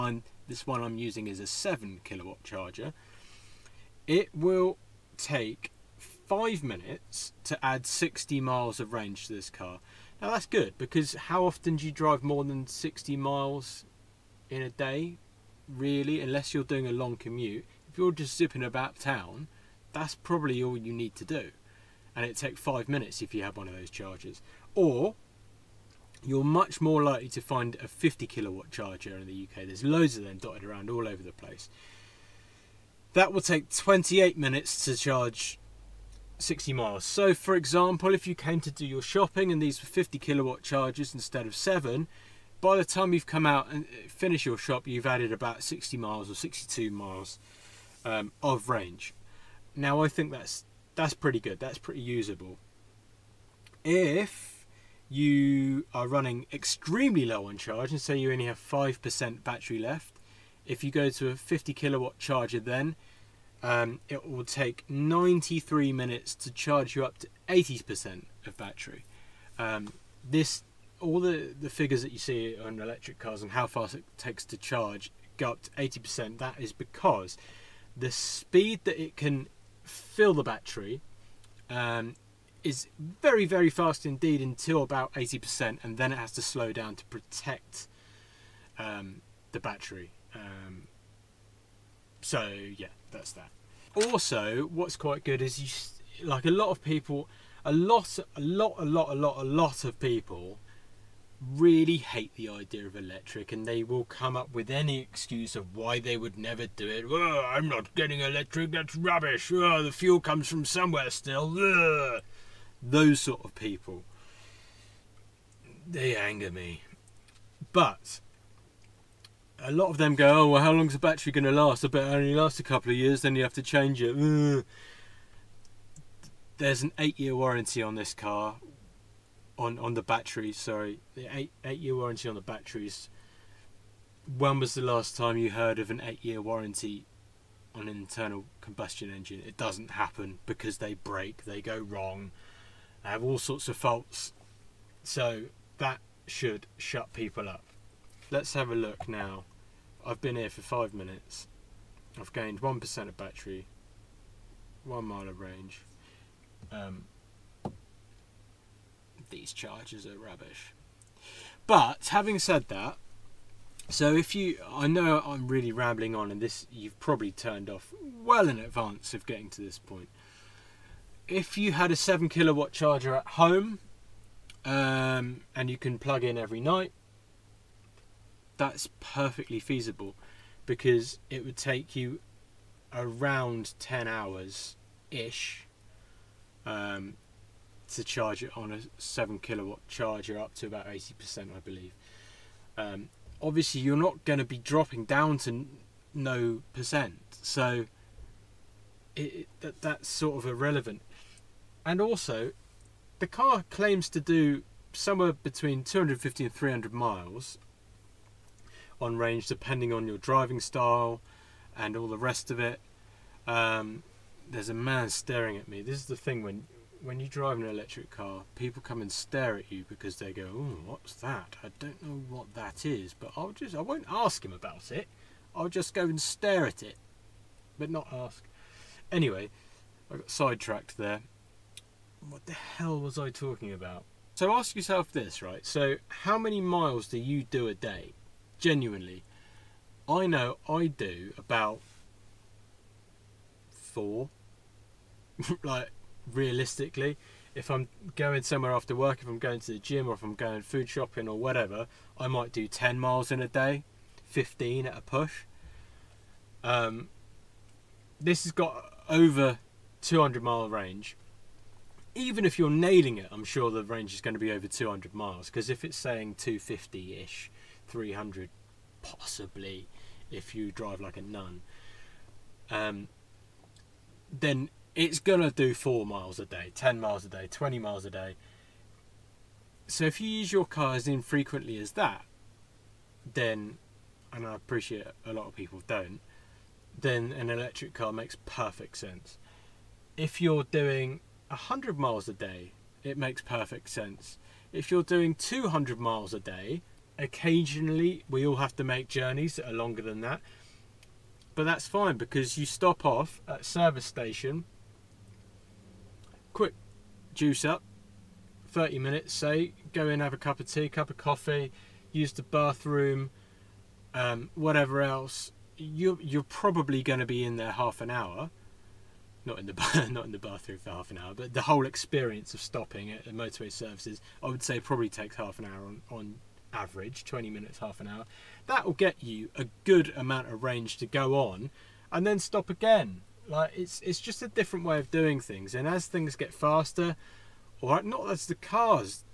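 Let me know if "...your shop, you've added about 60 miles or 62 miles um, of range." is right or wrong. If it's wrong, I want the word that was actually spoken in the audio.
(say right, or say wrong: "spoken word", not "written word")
right.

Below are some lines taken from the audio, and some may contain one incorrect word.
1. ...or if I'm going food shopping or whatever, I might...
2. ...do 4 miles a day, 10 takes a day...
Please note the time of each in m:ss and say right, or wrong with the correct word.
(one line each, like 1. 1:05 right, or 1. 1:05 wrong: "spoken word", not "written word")
1. 4:10 right
2. 4:35 wrong: "miles", not "takes".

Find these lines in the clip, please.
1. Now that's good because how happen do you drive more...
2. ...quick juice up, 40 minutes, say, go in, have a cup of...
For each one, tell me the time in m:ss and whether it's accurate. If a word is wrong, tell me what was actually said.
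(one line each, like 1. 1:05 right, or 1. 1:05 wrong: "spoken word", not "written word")
1. 0:10 wrong: "often", not "happen"
2. 5:06 wrong: "30", not "40".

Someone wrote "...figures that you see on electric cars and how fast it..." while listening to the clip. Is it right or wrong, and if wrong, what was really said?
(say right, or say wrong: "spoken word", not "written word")
right.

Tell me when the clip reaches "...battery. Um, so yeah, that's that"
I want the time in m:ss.
1:29.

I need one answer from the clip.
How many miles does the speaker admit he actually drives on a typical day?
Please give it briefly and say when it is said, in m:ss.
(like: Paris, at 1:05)
4, at 4:03.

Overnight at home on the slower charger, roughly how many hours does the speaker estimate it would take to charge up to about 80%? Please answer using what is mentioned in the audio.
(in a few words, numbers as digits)
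10 hours.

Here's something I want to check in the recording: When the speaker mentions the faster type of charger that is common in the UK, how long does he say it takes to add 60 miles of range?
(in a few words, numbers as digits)
28 minutes.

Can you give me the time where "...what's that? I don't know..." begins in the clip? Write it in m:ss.
3:40.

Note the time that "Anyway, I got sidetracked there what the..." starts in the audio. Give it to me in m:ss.
3:49.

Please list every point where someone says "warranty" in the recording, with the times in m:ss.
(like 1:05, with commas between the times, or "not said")
2:07, 2:11, 2:16.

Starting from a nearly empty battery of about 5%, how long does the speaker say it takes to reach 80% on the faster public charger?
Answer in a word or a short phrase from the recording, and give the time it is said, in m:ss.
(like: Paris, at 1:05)
93 minutes, at 1:04.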